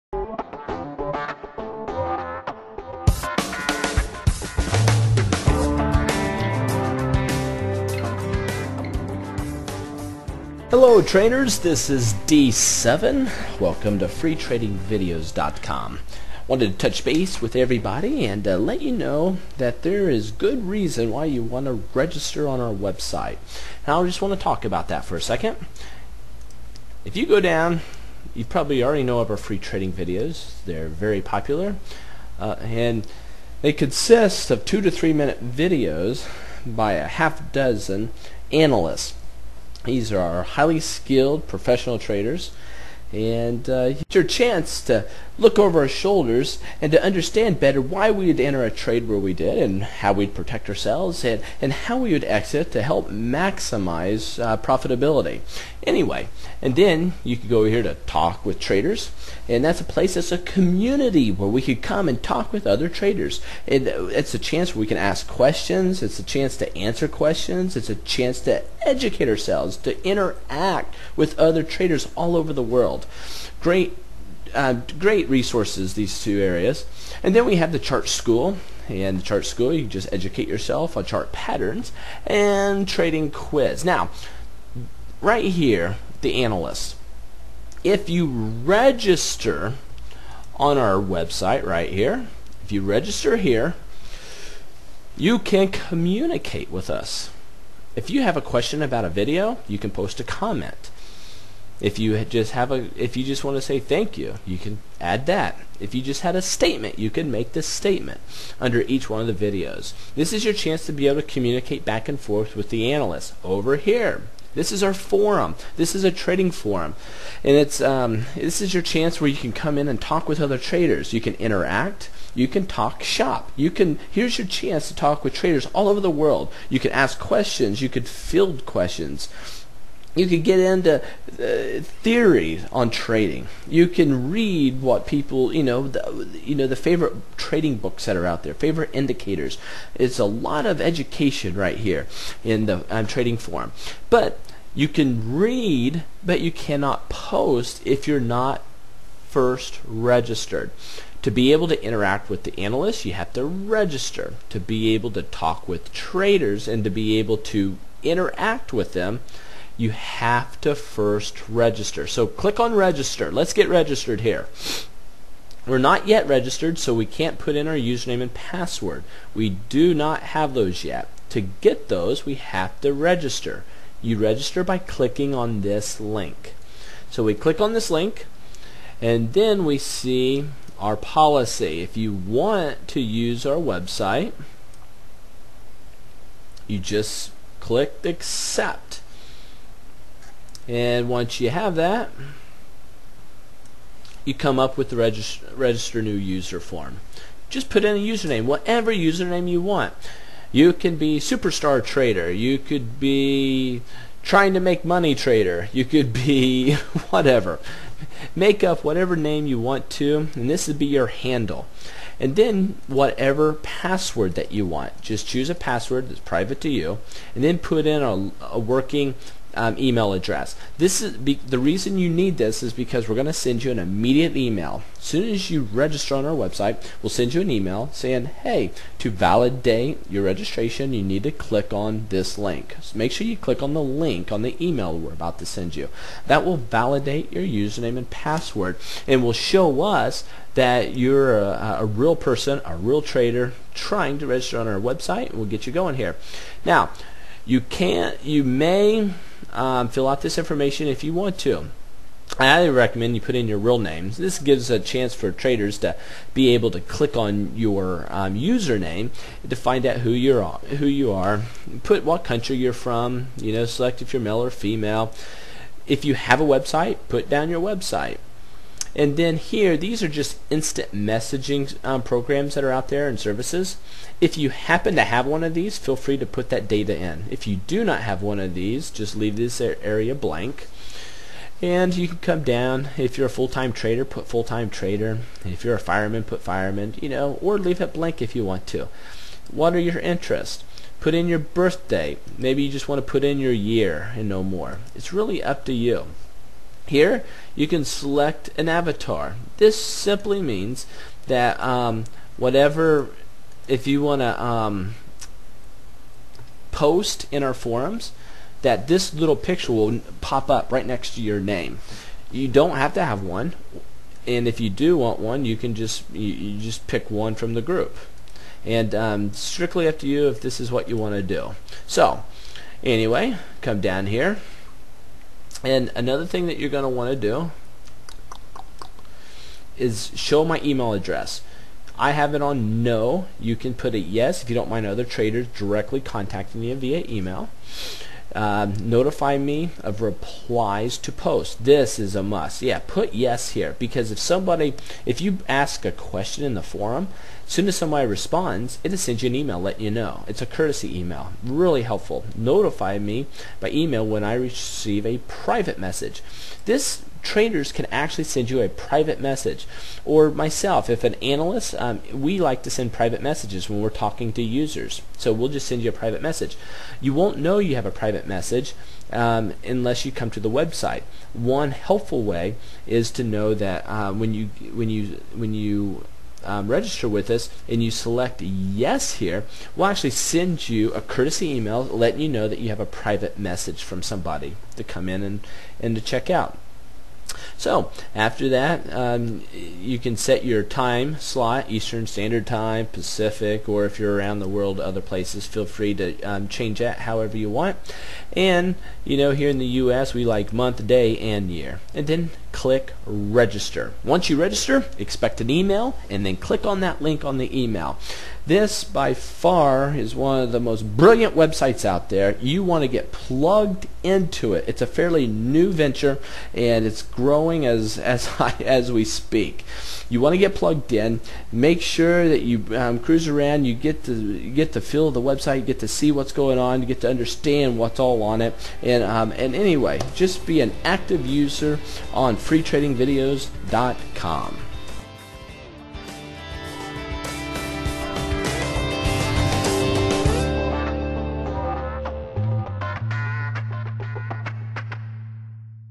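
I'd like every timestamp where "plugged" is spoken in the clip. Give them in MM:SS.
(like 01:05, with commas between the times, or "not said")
06:53, 07:00.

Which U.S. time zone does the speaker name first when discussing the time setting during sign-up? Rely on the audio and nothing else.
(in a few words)
Eastern Standard Time.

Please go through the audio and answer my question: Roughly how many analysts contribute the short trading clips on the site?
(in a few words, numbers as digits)
half dozen.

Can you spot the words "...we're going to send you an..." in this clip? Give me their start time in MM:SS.
03:43.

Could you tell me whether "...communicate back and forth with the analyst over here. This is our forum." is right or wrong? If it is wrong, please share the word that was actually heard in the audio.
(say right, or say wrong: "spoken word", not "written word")
right.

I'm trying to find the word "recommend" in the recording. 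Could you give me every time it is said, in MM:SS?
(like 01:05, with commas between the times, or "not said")
04:12.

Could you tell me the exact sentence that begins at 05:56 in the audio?
This traders can actually send you a private message.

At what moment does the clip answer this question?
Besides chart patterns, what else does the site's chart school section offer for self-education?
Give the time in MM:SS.
01:22.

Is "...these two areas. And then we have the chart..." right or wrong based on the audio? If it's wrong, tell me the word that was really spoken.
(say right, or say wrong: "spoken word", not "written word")
right.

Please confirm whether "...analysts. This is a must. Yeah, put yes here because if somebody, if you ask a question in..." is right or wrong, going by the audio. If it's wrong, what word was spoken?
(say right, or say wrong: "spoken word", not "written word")
wrong: "posts", not "analysts".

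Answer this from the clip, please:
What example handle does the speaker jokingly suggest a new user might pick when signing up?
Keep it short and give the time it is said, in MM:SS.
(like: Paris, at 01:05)
superstar trader, at 03:21.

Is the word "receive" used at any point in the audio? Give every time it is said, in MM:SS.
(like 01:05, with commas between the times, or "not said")
05:54.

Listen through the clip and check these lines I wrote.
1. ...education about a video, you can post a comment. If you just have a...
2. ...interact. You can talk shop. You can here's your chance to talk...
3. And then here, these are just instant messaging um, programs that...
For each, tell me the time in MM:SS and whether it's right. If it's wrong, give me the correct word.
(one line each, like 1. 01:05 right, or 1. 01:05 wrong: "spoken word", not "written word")
1. 01:38 wrong: "question", not "education"
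2. 02:01 right
3. 04:28 right.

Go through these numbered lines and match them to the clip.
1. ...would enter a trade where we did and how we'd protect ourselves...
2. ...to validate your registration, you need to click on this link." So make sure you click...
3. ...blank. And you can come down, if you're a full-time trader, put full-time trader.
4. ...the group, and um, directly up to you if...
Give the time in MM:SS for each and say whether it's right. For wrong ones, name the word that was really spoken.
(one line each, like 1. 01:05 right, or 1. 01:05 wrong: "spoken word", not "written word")
1. 00:48 right
2. 03:48 right
3. 04:40 right
4. 05:17 wrong: "strictly", not "directly".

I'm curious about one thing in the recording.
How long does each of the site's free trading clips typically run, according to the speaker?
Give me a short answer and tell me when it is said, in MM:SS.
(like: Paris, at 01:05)
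2 to 3 minutes, at 00:34.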